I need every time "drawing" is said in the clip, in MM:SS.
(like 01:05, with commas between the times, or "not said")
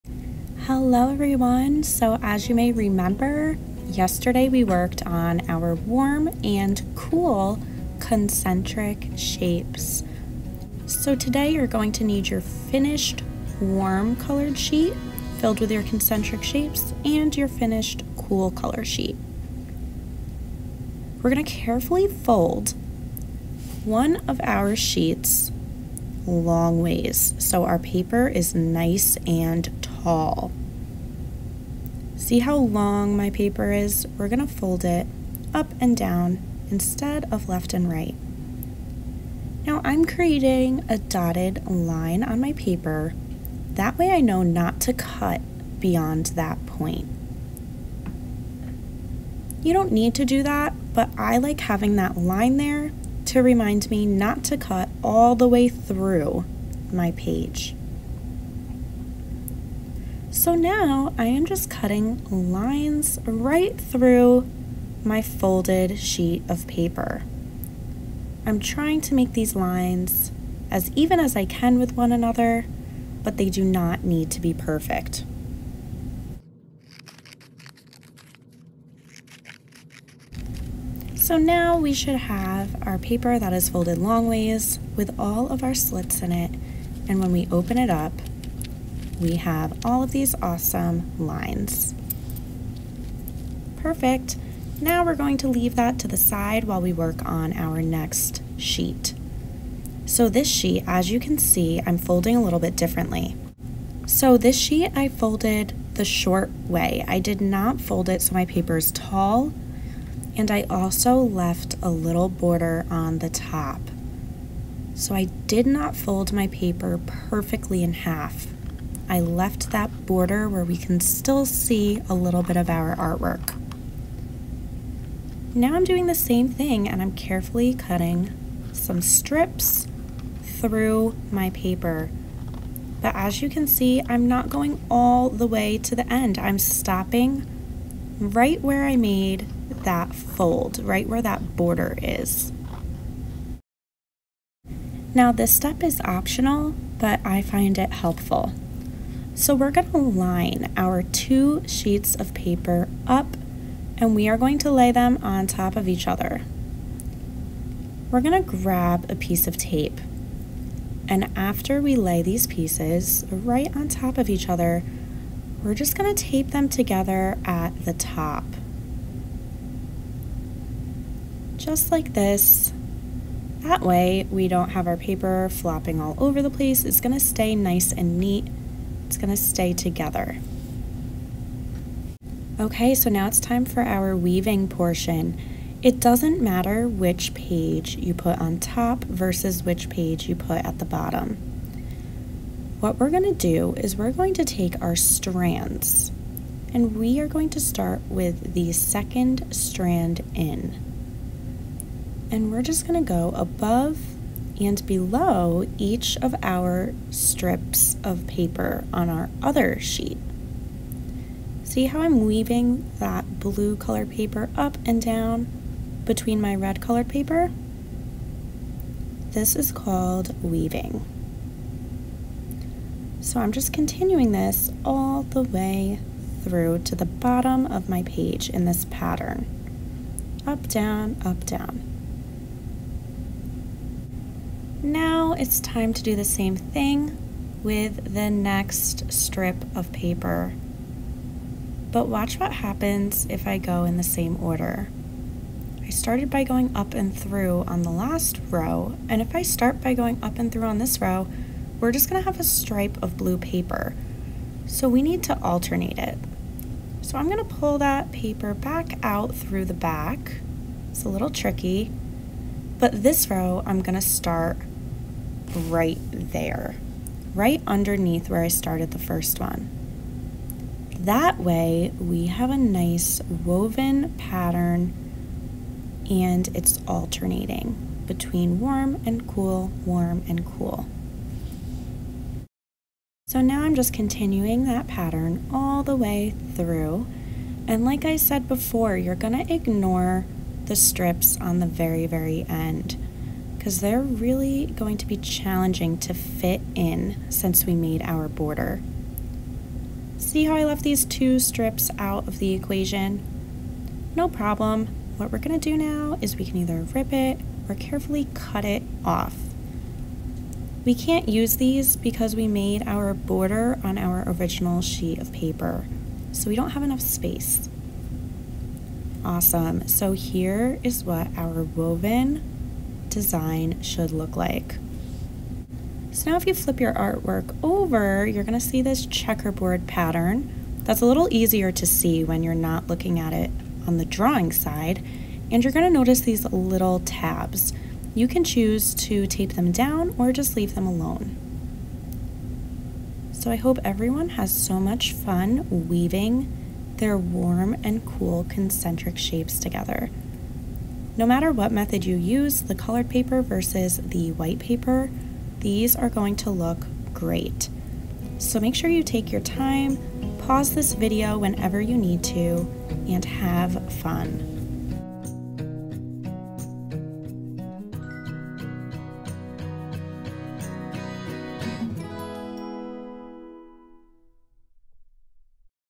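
05:34.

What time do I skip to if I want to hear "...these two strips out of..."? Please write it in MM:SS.
05:00.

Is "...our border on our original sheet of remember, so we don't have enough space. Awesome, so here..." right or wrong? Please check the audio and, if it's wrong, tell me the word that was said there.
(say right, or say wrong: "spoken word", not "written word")
wrong: "paper", not "remember".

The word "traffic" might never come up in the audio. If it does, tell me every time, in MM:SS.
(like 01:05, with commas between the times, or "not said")
not said.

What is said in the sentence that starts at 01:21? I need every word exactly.
So now we should have our paper that is folded long ways with all of our slits in it.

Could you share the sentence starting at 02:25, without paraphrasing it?
Now this step is optional, but I find it helpful.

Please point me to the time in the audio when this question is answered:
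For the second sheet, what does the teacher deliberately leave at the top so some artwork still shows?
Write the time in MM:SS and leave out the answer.
01:51.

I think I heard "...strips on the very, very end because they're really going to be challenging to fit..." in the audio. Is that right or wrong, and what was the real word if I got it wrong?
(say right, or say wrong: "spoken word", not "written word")
right.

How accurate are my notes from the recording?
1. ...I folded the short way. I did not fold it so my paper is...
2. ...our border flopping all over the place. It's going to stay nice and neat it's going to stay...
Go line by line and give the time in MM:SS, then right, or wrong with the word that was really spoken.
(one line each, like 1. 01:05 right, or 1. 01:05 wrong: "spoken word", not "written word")
1. 01:44 right
2. 02:54 wrong: "paper", not "border".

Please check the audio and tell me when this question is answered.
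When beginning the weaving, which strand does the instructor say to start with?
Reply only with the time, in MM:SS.
03:18.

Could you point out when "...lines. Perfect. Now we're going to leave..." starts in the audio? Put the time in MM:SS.
01:31.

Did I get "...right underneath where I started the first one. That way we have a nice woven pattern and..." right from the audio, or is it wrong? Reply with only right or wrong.
right.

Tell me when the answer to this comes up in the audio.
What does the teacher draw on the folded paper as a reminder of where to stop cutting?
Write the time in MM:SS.
00:40.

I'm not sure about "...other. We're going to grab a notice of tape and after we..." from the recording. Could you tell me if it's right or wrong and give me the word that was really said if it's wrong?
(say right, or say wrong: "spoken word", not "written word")
wrong: "piece", not "notice".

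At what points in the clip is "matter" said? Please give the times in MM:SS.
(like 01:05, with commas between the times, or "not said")
03:06, 05:51.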